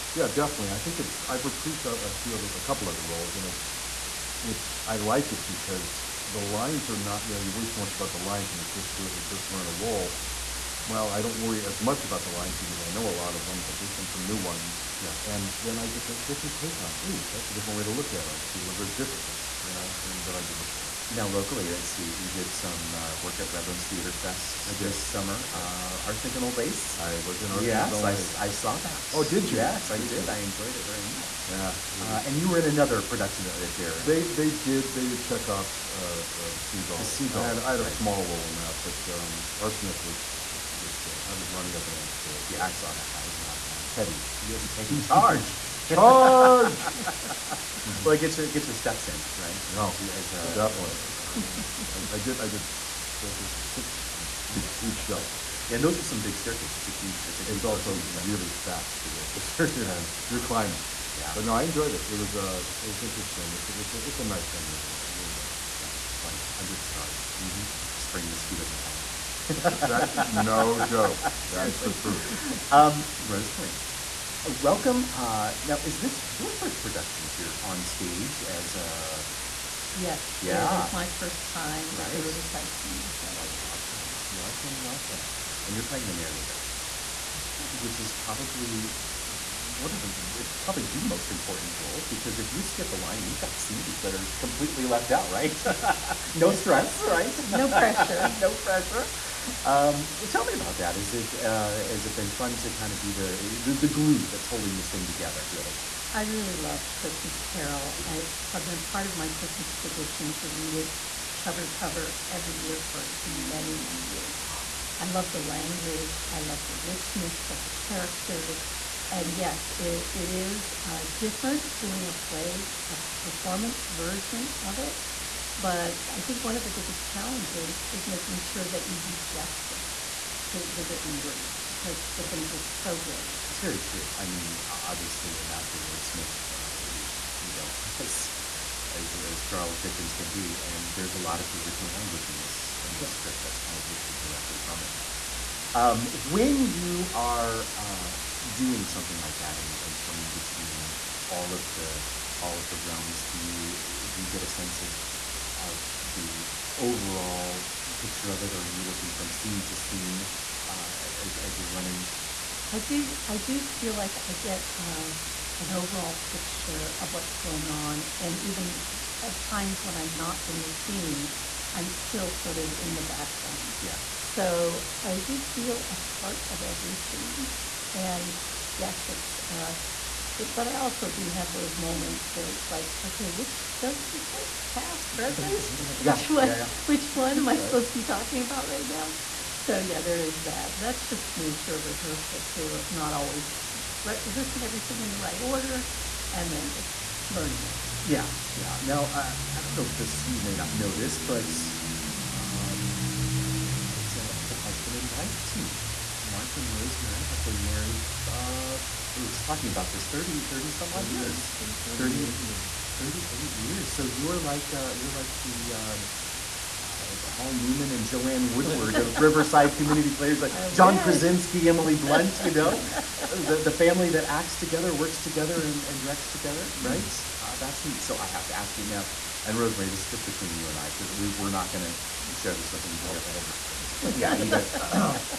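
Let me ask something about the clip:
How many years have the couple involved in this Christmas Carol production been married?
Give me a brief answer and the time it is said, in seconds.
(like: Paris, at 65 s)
38, at 212 s.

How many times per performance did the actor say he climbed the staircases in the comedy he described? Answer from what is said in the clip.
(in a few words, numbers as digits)
6.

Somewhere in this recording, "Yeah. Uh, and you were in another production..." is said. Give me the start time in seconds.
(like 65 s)
31 s.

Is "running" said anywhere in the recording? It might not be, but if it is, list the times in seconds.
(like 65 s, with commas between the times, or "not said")
41 s, 161 s.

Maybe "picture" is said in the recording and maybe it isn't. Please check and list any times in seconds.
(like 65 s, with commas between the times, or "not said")
157 s, 166 s.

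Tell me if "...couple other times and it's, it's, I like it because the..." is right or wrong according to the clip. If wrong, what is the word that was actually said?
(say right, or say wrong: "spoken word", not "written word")
wrong: "roles", not "times".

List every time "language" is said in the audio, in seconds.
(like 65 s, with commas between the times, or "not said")
115 s, 141 s.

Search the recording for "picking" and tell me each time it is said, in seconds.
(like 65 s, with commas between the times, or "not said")
not said.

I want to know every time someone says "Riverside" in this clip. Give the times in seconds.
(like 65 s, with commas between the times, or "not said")
82 s, 219 s.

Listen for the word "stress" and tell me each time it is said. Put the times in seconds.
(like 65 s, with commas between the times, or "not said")
96 s.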